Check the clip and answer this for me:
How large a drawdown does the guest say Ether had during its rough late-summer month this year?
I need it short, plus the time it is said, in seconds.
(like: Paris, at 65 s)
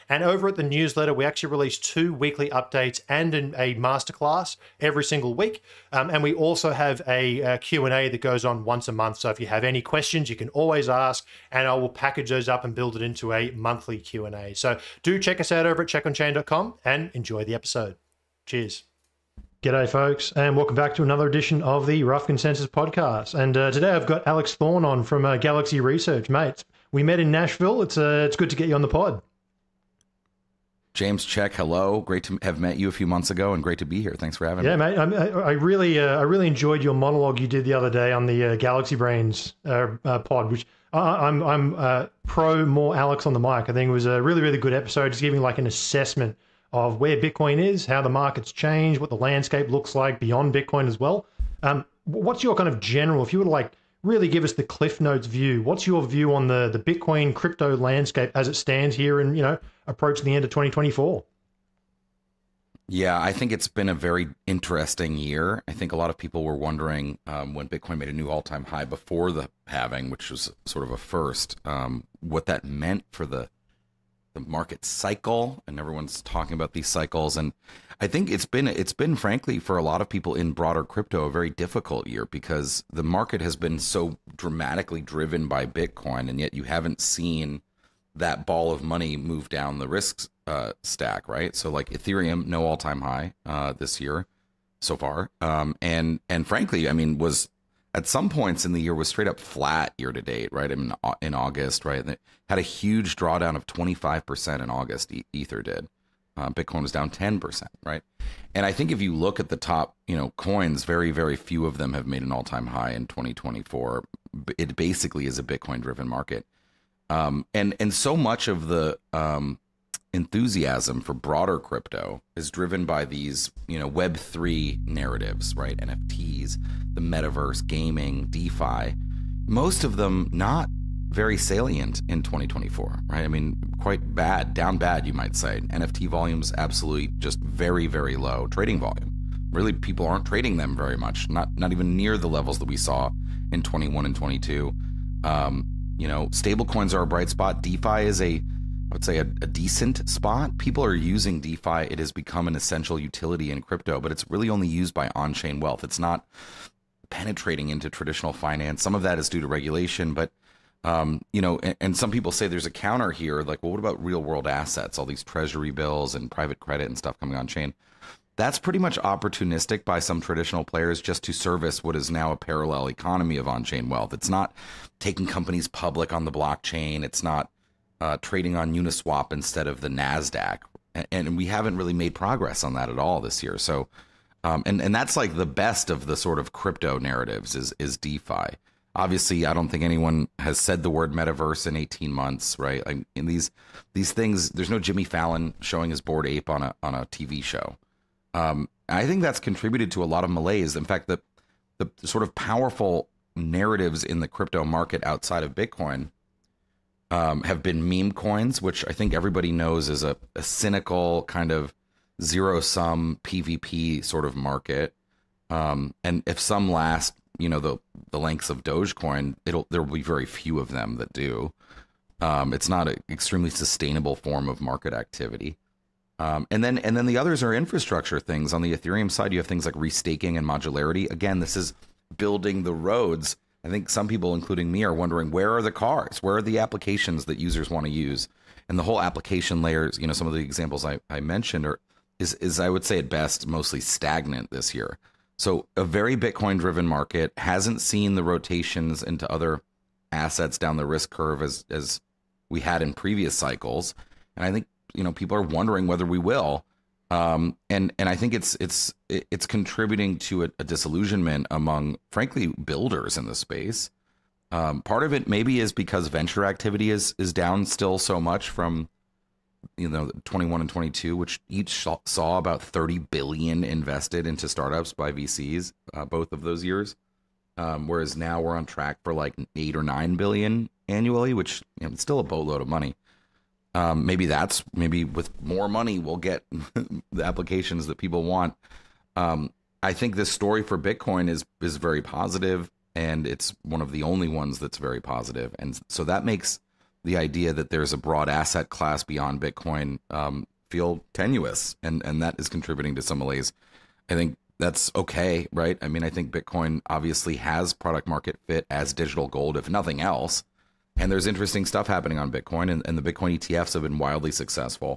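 25%, at 103 s.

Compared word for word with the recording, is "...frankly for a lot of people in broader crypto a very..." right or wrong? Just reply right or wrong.
right.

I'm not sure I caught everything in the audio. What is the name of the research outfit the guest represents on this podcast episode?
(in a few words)
Galaxy Research.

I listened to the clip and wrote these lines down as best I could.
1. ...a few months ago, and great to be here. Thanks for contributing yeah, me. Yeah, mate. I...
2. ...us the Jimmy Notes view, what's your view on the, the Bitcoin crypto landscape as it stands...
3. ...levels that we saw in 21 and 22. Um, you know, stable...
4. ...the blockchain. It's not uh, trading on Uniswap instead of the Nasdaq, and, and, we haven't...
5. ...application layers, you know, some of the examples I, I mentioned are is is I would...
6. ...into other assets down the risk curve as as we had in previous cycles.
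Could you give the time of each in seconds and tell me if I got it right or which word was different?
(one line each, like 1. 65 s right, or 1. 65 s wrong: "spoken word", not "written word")
1. 32 s wrong: "having", not "contributing"
2. 54 s wrong: "Cliff", not "Jimmy"
3. 142 s right
4. 176 s right
5. 239 s right
6. 249 s right.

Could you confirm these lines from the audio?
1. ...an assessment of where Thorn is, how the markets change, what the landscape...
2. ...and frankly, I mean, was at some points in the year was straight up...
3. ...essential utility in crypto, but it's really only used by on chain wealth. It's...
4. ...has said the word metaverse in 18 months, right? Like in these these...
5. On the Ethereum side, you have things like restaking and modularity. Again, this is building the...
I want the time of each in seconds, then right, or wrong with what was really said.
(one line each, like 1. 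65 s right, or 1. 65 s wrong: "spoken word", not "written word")
1. 45 s wrong: "Bitcoin", not "Thorn"
2. 96 s right
3. 152 s right
4. 190 s right
5. 228 s right.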